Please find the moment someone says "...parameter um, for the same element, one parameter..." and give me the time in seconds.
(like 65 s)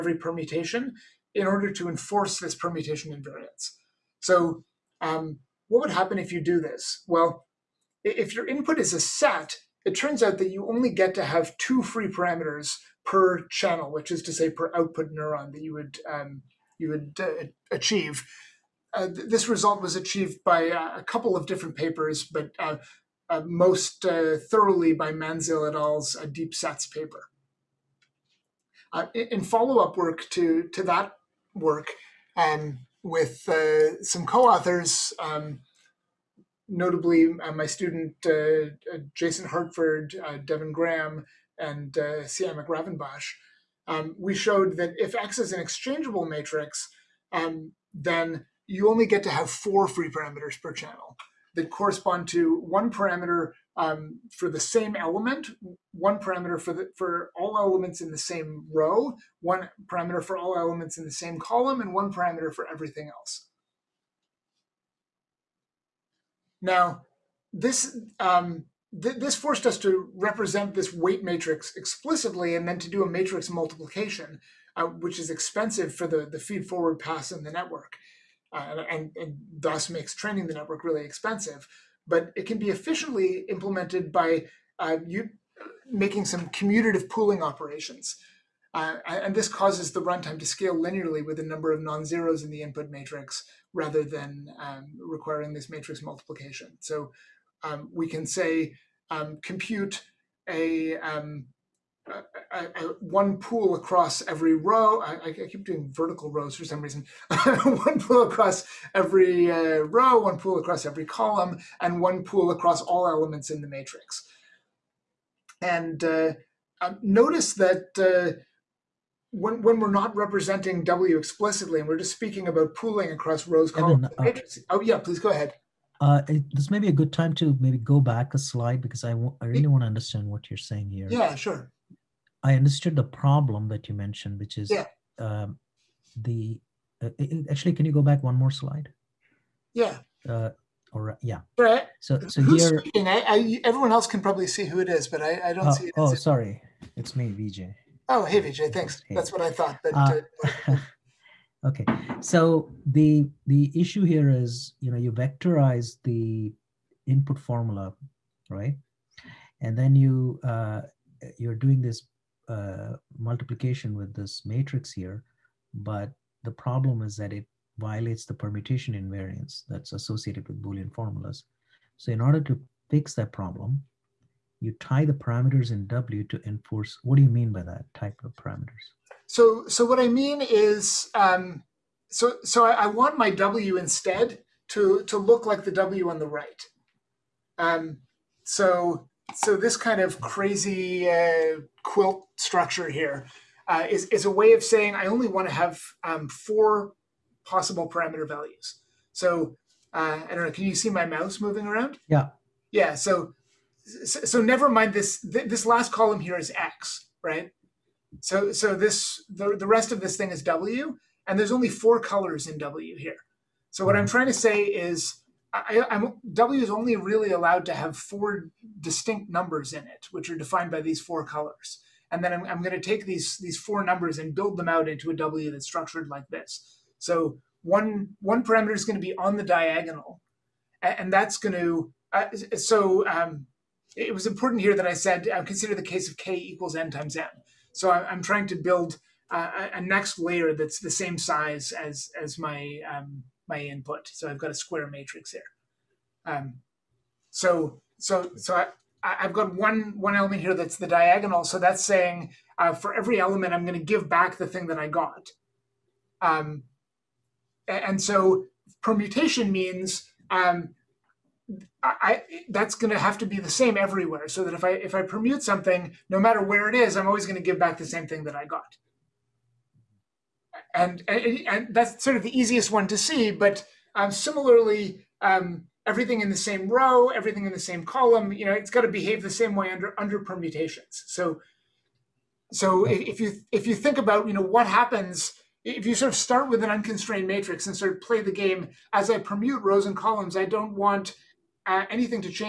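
52 s.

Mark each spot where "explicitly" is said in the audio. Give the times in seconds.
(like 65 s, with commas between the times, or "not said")
71 s, 121 s.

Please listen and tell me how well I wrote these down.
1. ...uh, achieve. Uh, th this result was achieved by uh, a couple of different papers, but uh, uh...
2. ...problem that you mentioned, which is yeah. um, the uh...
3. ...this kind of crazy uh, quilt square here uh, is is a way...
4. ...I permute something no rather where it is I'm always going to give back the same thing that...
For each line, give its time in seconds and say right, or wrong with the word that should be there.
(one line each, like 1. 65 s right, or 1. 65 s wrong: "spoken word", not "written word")
1. 17 s right
2. 133 s right
3. 189 s wrong: "structure", not "square"
4. 264 s wrong: "matter", not "rather".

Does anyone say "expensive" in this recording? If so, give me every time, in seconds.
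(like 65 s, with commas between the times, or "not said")
75 s, 81 s.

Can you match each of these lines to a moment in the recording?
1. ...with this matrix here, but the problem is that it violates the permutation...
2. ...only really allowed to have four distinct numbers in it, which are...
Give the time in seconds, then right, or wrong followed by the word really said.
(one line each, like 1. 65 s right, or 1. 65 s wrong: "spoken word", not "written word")
1. 163 s right
2. 216 s right.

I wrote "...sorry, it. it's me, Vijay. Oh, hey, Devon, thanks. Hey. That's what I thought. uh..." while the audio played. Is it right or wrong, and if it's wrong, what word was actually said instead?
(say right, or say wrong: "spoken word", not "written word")
wrong: "Vijay", not "Devon".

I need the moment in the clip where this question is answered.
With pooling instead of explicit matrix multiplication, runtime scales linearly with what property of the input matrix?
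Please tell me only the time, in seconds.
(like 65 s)
91 s.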